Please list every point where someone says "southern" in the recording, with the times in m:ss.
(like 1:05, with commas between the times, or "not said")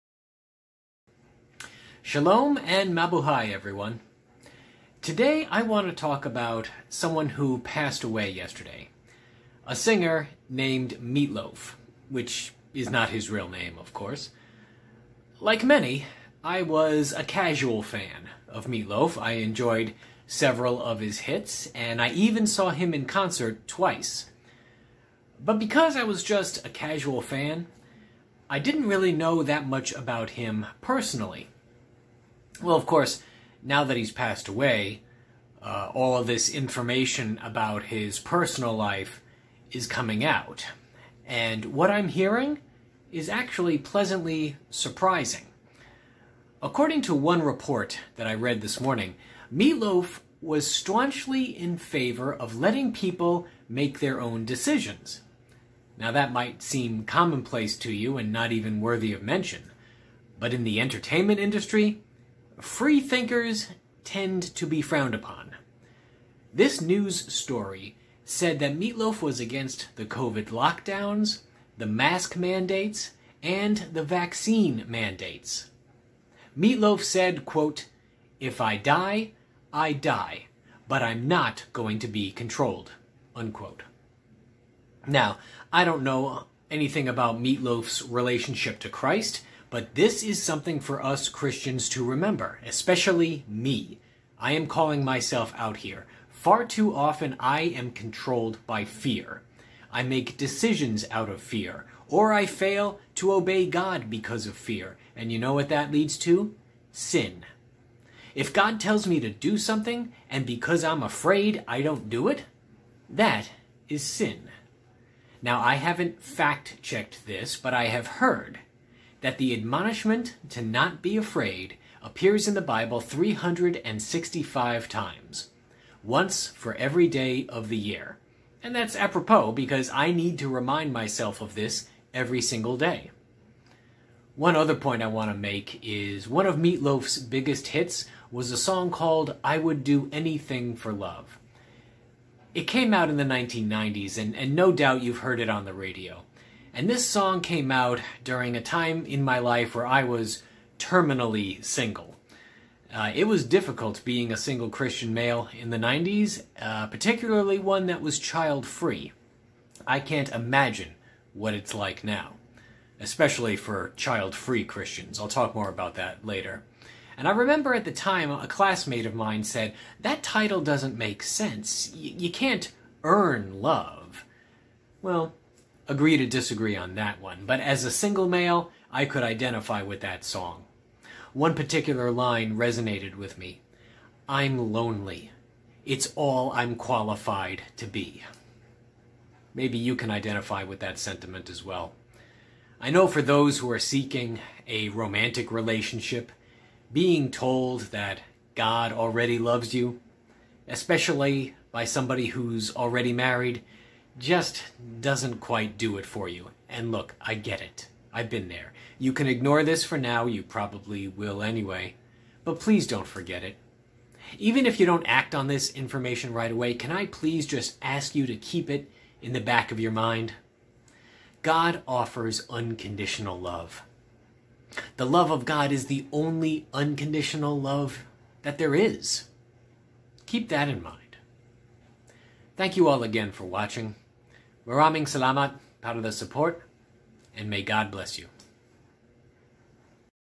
not said.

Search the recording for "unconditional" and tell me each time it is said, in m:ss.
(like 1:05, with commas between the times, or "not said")
3:42, 3:46.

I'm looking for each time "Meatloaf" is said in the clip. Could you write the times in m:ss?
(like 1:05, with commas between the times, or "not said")
0:10, 0:18, 0:49, 1:08, 1:16, 1:27, 2:16.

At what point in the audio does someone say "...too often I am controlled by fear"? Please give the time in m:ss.
1:36.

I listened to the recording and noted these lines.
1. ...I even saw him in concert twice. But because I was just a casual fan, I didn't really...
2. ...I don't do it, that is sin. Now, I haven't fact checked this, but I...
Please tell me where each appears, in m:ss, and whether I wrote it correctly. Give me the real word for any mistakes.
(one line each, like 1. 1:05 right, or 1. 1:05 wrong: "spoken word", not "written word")
1. 0:22 right
2. 1:51 right.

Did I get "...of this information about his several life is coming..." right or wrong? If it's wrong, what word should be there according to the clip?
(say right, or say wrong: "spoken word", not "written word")
wrong: "personal", not "several".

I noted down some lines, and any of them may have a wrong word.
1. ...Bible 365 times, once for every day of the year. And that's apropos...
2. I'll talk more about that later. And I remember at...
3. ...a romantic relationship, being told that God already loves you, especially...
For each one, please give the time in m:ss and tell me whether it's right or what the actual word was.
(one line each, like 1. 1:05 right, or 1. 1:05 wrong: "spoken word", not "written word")
1. 2:02 right
2. 2:45 right
3. 3:14 right.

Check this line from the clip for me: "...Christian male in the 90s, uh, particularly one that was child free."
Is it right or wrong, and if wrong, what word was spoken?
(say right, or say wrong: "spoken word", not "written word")
right.